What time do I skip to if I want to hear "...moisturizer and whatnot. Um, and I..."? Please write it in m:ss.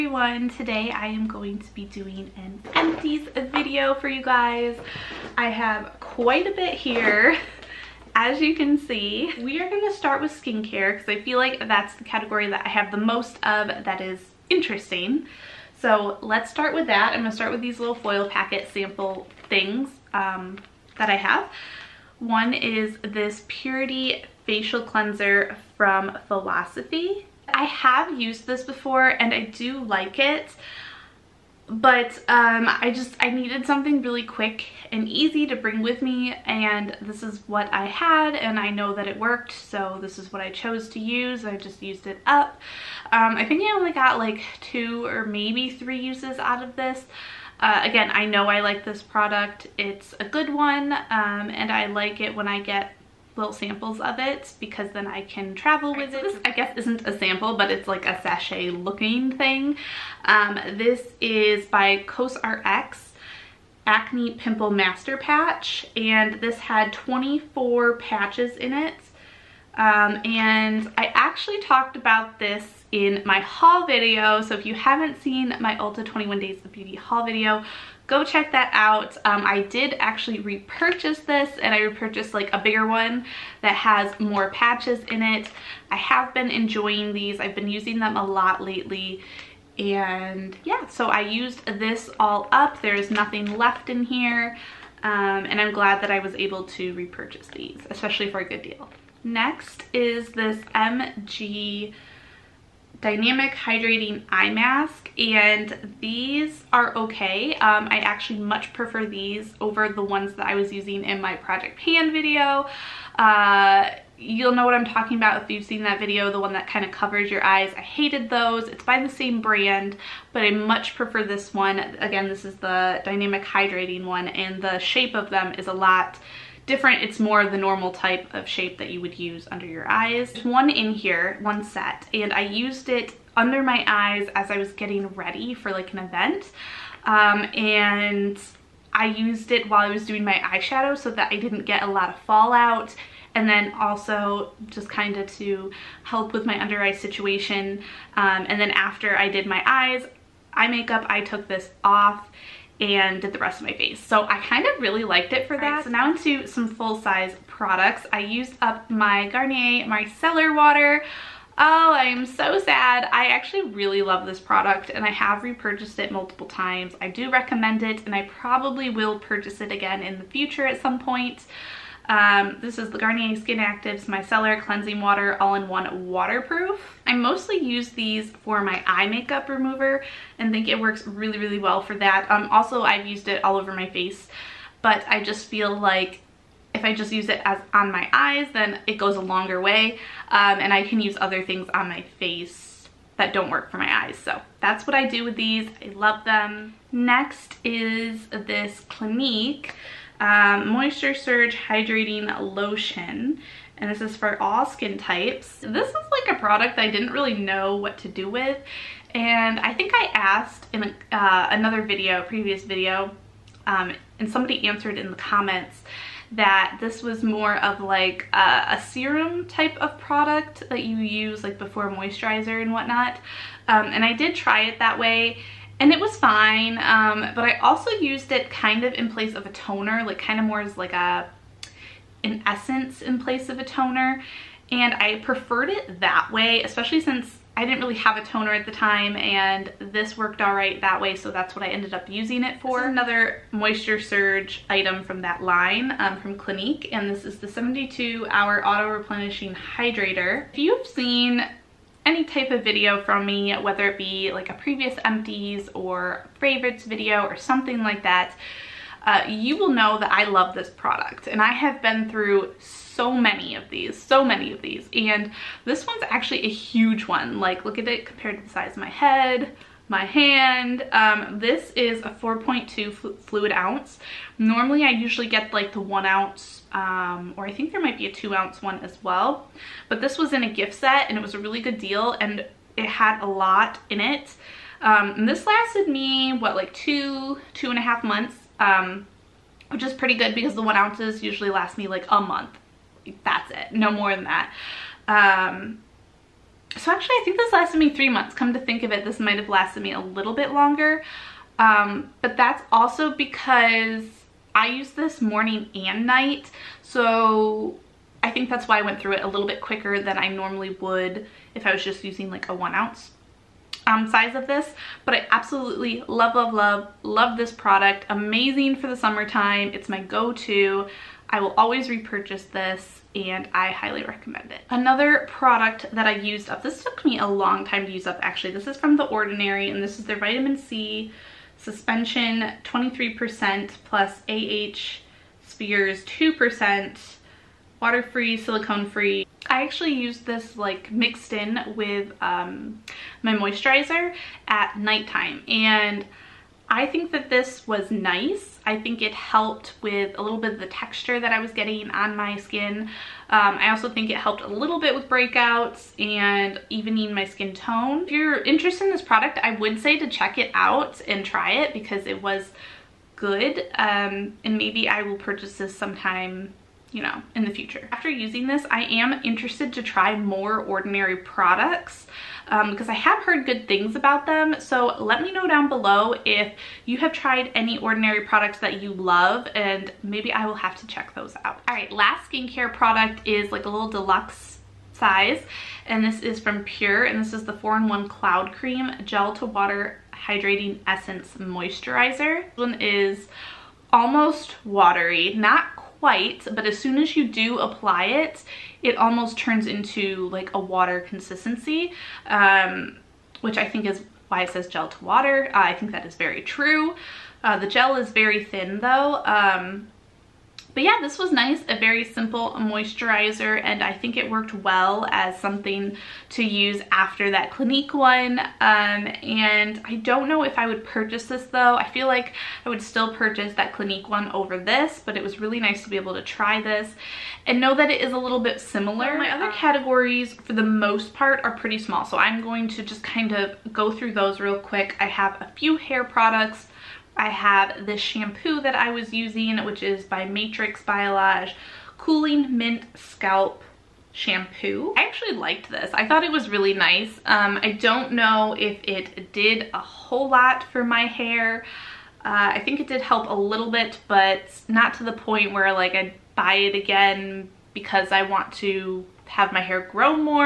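3:41.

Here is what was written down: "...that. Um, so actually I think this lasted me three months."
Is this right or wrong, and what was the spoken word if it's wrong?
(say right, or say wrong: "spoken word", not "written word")
right.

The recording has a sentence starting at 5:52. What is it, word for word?
Um, I also think it helped a little bit with breakouts and evening my skin tone.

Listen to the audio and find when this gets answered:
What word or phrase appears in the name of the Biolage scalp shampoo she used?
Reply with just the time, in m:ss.
7:21.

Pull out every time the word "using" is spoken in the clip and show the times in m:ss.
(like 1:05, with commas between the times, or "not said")
1:27, 1:50, 4:02, 5:12, 6:08, 7:19.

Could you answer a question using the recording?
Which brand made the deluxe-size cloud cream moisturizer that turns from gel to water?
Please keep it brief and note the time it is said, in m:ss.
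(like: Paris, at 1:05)
PUR, at 6:26.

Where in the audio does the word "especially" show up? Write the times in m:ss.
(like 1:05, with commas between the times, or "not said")
1:37, 3:56.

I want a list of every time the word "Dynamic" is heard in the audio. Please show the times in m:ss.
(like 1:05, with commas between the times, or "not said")
1:42, 2:03.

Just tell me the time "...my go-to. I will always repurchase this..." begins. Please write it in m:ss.
5:19.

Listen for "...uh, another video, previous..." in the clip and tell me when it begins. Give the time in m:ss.
3:31.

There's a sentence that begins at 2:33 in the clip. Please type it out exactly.
So I kind of really liked it for that.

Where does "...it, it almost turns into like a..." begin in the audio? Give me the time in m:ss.
6:38.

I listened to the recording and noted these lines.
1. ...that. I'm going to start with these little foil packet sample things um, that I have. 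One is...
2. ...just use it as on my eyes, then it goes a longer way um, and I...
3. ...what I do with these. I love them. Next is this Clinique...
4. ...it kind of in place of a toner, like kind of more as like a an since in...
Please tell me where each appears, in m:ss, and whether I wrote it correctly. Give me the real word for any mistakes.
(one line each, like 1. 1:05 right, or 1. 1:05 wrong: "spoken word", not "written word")
1. 0:16 right
2. 3:06 right
3. 3:14 right
4. 3:48 wrong: "essence", not "since".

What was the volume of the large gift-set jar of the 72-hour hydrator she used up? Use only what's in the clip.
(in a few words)
4.2 fl oz.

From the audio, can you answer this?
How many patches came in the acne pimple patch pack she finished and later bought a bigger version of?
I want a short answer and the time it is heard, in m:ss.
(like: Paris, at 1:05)
24, at 1:06.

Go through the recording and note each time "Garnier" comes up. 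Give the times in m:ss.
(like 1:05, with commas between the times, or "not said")
2:39, 2:52.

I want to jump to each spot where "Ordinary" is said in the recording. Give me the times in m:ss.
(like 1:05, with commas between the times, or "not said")
5:29, 6:10, 6:17.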